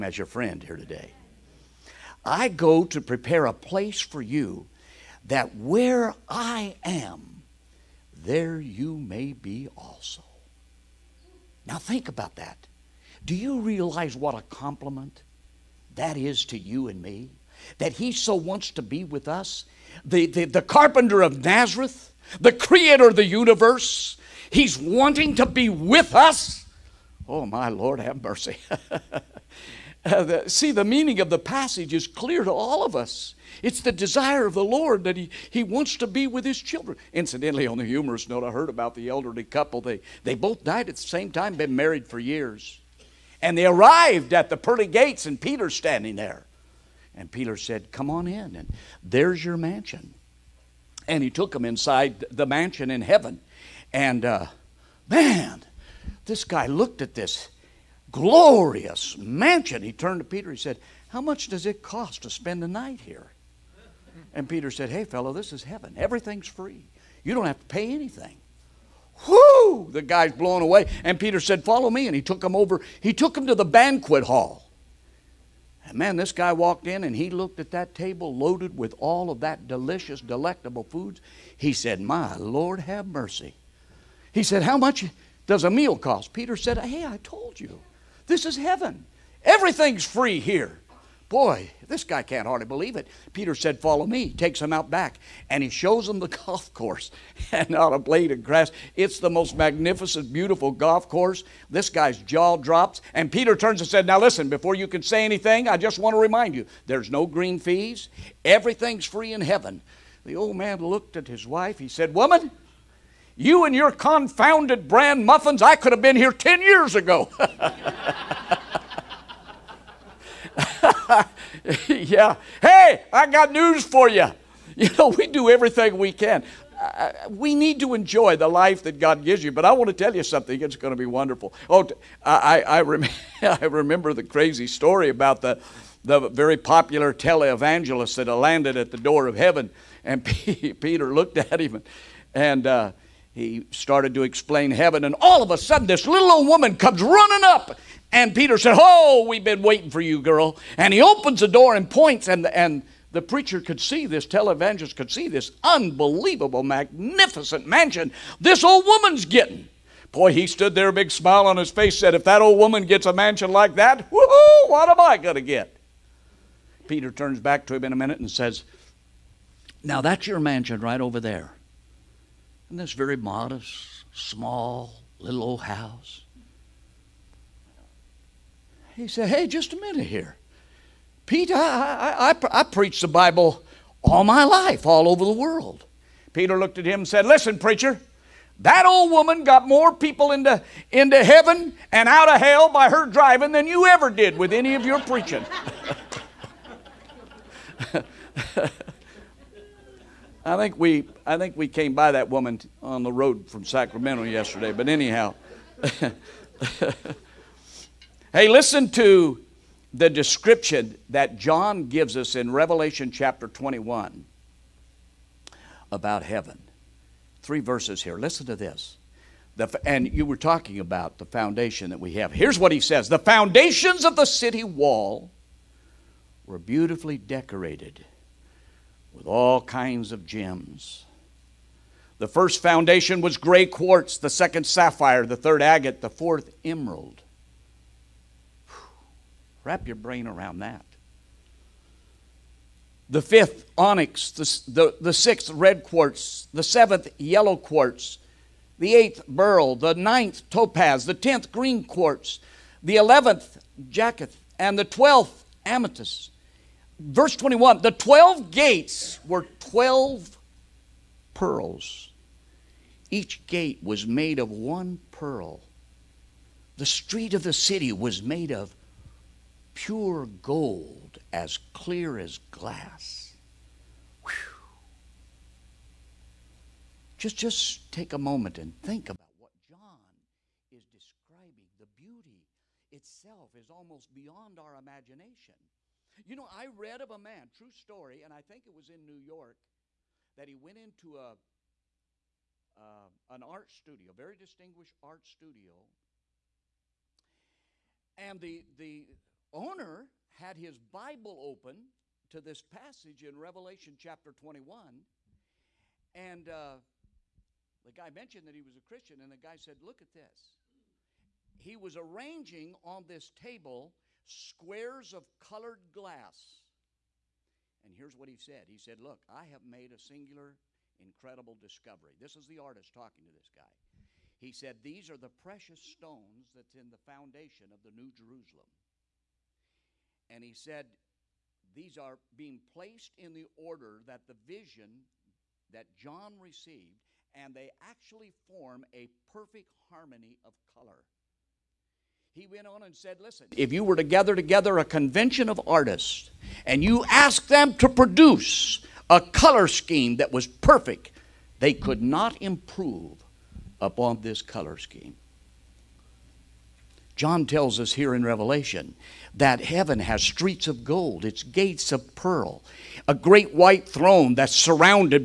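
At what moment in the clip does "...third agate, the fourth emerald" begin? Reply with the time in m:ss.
3:55.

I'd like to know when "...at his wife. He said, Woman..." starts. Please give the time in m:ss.
1:51.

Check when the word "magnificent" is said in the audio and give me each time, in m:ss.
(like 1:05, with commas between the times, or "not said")
1:39, 2:36.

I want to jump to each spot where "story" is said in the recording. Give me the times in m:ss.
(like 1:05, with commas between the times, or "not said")
2:14, 4:47.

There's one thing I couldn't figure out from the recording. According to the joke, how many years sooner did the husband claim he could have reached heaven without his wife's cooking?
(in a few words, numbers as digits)
10 years.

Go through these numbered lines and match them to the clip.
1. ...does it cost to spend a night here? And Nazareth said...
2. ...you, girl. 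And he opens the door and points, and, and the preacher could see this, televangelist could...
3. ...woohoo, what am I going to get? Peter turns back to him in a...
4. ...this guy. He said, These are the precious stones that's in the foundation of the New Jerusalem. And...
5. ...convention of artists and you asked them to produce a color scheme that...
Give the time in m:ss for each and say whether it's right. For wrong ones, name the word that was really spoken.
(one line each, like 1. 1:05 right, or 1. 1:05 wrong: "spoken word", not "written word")
1. 1:01 wrong: "Peter", not "Nazareth"
2. 2:30 right
3. 2:44 right
4. 5:23 right
5. 5:44 right.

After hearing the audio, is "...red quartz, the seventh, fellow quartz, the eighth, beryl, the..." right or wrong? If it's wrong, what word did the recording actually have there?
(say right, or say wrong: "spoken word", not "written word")
wrong: "yellow", not "fellow".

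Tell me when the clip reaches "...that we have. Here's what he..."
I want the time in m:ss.
3:41.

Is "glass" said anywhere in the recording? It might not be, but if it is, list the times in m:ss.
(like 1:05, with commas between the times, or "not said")
4:32, 5:15.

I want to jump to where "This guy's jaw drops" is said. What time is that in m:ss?
1:41.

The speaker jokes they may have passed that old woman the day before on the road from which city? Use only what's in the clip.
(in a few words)
Sacramento.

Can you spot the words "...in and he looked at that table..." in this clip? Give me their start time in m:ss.
1:16.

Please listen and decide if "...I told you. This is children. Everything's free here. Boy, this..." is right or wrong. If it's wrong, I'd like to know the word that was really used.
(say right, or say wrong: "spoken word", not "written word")
wrong: "heaven", not "children".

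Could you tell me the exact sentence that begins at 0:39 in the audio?
They, they both died at the same time, been married for years.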